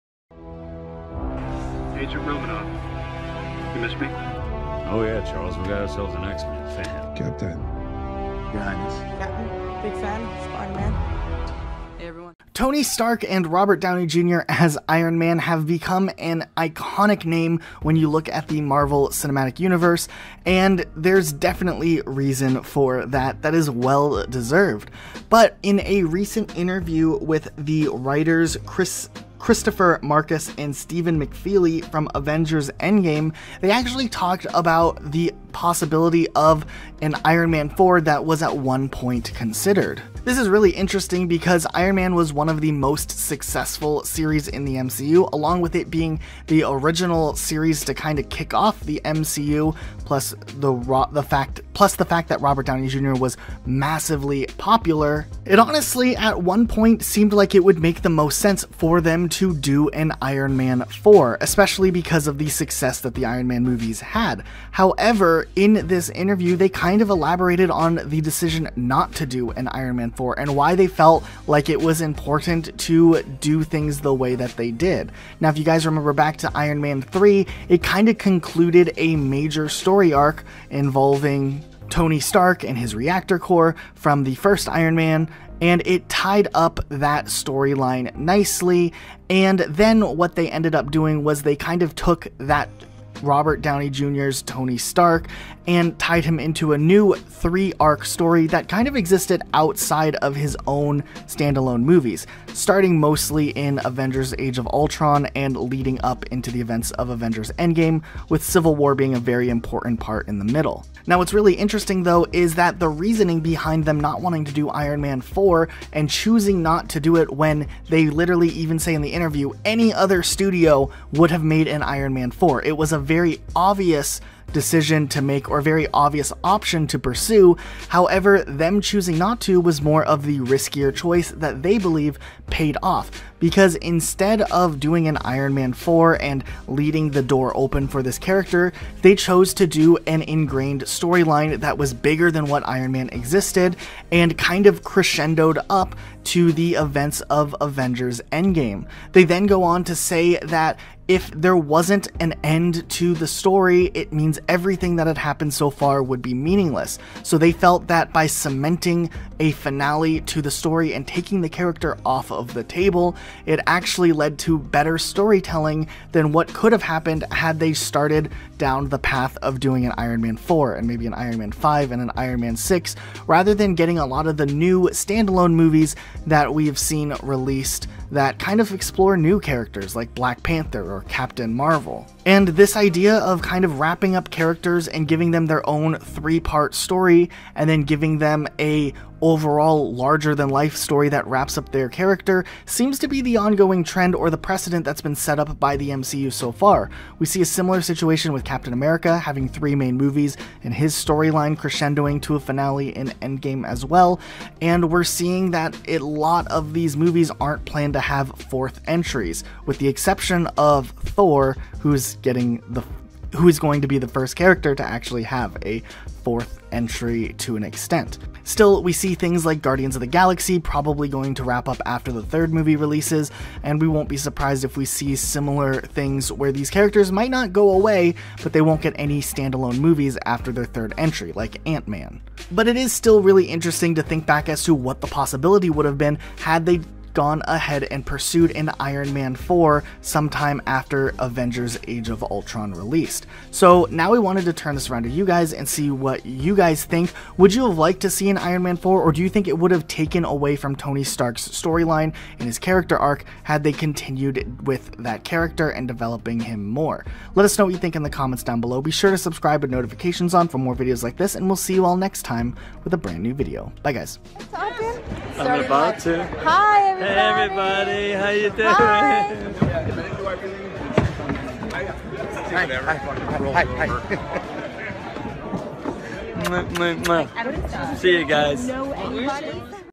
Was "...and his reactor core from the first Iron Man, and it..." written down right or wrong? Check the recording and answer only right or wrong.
right.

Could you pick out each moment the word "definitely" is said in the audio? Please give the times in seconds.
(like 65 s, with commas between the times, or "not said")
21 s.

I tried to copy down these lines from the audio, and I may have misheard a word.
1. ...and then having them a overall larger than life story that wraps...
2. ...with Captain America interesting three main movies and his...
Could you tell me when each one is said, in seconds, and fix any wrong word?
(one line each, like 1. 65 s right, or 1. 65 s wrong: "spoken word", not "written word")
1. 187 s wrong: "giving", not "having"
2. 198 s wrong: "having", not "interesting".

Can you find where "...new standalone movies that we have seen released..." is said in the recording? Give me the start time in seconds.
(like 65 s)
174 s.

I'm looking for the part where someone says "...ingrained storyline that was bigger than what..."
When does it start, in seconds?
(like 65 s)
140 s.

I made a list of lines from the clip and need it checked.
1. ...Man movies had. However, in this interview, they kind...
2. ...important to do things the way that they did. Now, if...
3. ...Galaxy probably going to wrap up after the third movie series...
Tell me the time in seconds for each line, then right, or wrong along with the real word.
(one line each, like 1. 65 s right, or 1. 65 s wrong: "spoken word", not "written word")
1. 63 s right
2. 72 s right
3. 220 s wrong: "releases", not "series".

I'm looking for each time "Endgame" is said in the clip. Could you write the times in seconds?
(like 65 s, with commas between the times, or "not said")
32 s, 107 s, 148 s, 203 s.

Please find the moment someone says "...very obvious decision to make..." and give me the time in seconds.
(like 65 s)
123 s.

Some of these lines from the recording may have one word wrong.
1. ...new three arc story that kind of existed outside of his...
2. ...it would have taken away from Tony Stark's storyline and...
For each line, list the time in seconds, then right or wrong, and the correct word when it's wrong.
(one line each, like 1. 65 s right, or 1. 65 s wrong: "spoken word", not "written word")
1. 96 s right
2. 249 s right.